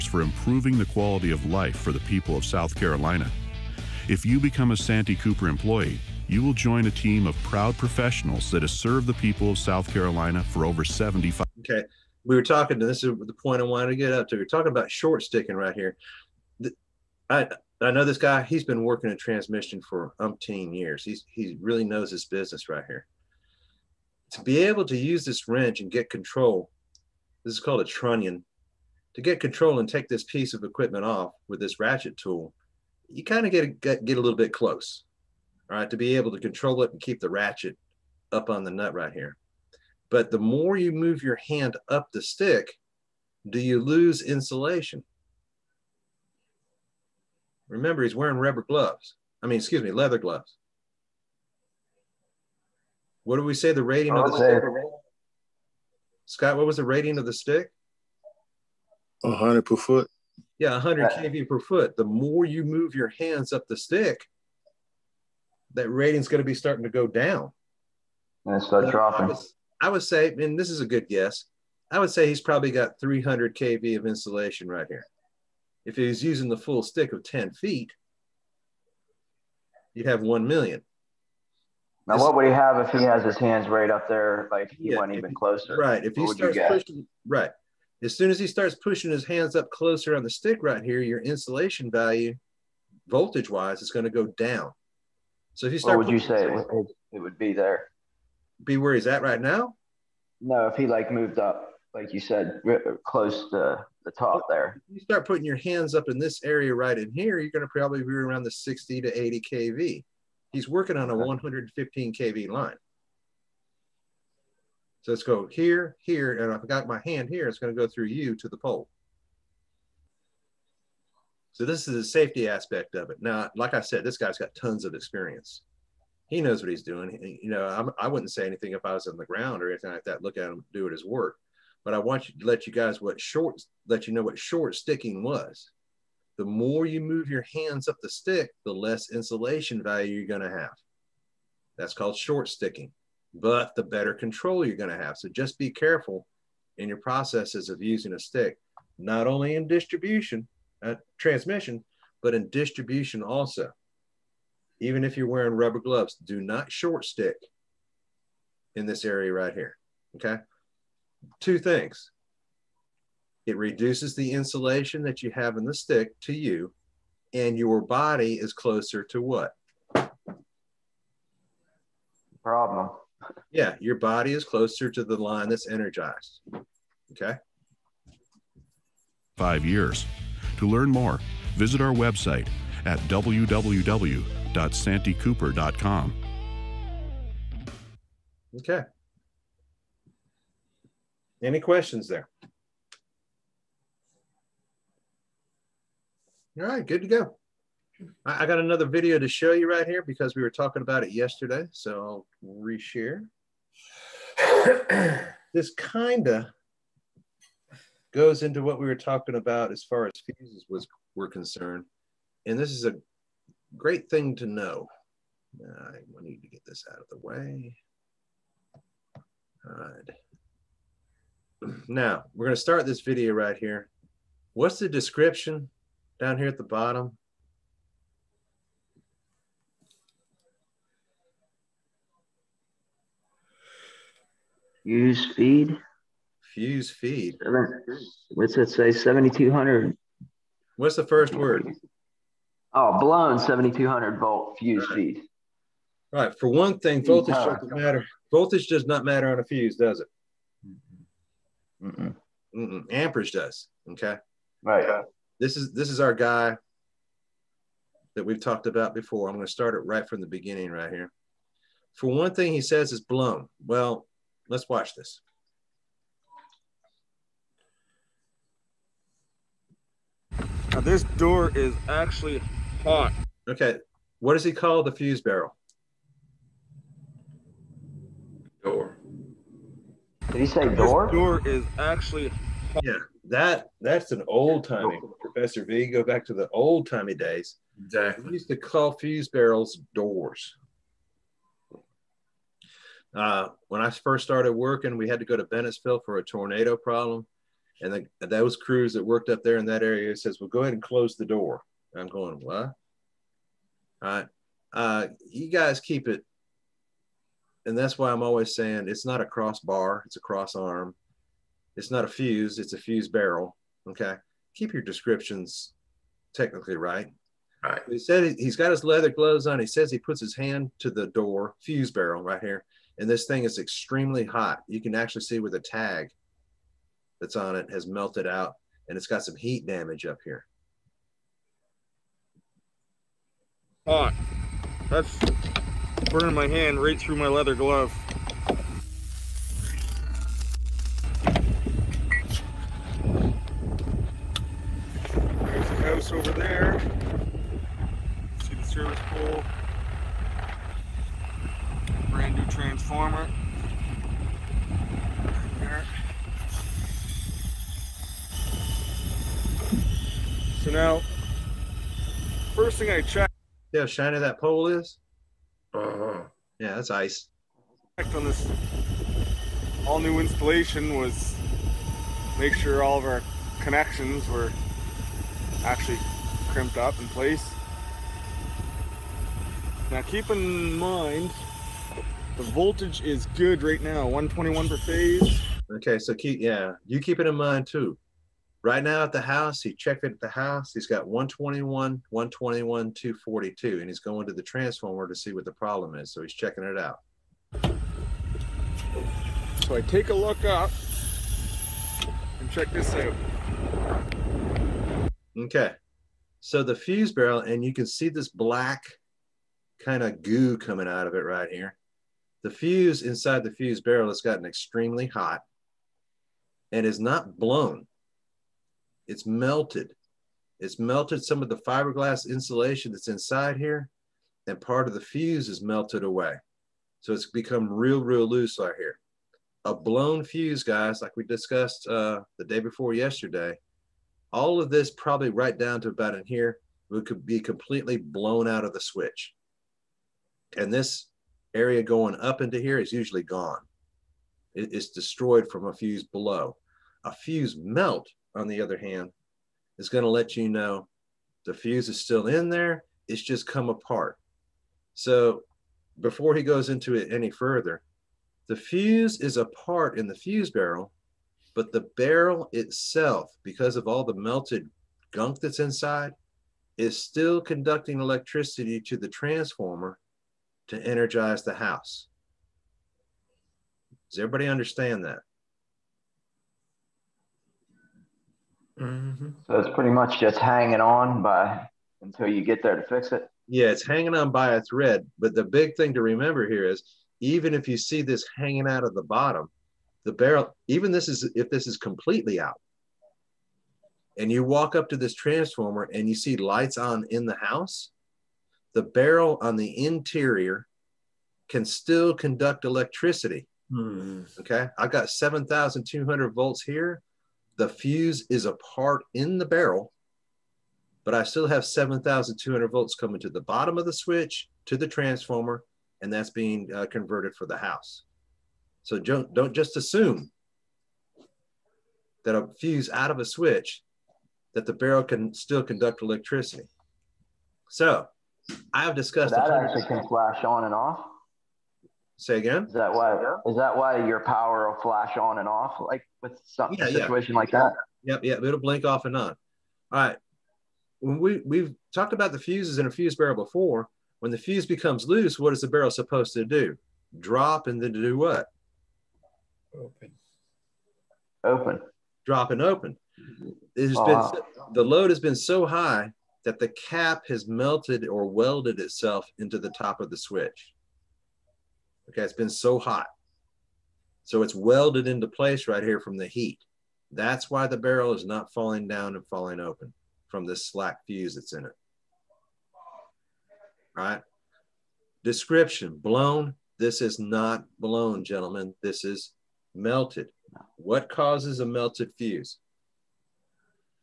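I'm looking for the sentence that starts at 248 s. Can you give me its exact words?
Voltage does not matter on a fuse, does it?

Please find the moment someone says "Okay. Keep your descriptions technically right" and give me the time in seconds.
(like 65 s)
313 s.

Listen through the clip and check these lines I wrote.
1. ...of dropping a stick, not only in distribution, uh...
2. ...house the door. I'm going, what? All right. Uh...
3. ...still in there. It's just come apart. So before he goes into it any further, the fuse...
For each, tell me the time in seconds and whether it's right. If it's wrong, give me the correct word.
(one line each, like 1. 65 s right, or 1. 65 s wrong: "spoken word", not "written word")
1. 147 s wrong: "using", not "dropping"
2. 300 s wrong: "close", not "house"
3. 452 s right.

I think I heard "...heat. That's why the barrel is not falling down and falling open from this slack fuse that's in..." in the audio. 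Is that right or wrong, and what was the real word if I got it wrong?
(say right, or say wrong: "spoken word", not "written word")
right.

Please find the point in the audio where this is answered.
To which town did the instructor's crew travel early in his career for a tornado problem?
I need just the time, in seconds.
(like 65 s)
295 s.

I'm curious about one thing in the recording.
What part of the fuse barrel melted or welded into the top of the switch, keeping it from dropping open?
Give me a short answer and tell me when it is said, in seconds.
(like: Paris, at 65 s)
the cap, at 556 s.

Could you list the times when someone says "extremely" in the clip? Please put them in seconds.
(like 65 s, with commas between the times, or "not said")
323 s, 414 s.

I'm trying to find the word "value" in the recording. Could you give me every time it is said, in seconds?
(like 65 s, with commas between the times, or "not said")
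91 s, 139 s.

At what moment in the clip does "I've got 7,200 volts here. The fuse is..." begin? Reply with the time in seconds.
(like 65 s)
504 s.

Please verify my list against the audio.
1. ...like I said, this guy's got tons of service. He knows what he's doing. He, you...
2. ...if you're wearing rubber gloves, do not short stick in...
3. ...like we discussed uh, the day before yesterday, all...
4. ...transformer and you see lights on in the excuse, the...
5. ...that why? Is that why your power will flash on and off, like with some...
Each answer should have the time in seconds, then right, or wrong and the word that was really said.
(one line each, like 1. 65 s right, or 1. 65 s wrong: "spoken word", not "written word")
1. 123 s wrong: "experience", not "service"
2. 155 s right
3. 431 s right
4. 495 s wrong: "house", not "excuse"
5. 532 s right.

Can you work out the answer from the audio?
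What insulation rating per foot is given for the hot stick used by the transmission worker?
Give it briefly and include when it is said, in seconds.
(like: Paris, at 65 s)
100 kV per foot, at 60 s.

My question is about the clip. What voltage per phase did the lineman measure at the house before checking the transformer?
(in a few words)
121.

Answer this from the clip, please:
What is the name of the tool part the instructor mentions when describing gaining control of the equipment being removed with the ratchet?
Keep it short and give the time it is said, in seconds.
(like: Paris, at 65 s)
trunnion, at 27 s.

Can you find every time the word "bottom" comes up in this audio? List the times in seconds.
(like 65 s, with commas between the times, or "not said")
226 s, 489 s, 513 s.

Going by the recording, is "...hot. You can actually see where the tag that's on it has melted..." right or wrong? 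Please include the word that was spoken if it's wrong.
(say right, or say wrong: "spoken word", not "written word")
right.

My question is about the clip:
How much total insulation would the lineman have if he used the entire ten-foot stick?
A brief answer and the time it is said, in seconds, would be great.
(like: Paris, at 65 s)
1 million, at 80 s.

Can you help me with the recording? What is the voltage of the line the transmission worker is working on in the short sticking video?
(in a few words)
115 kV.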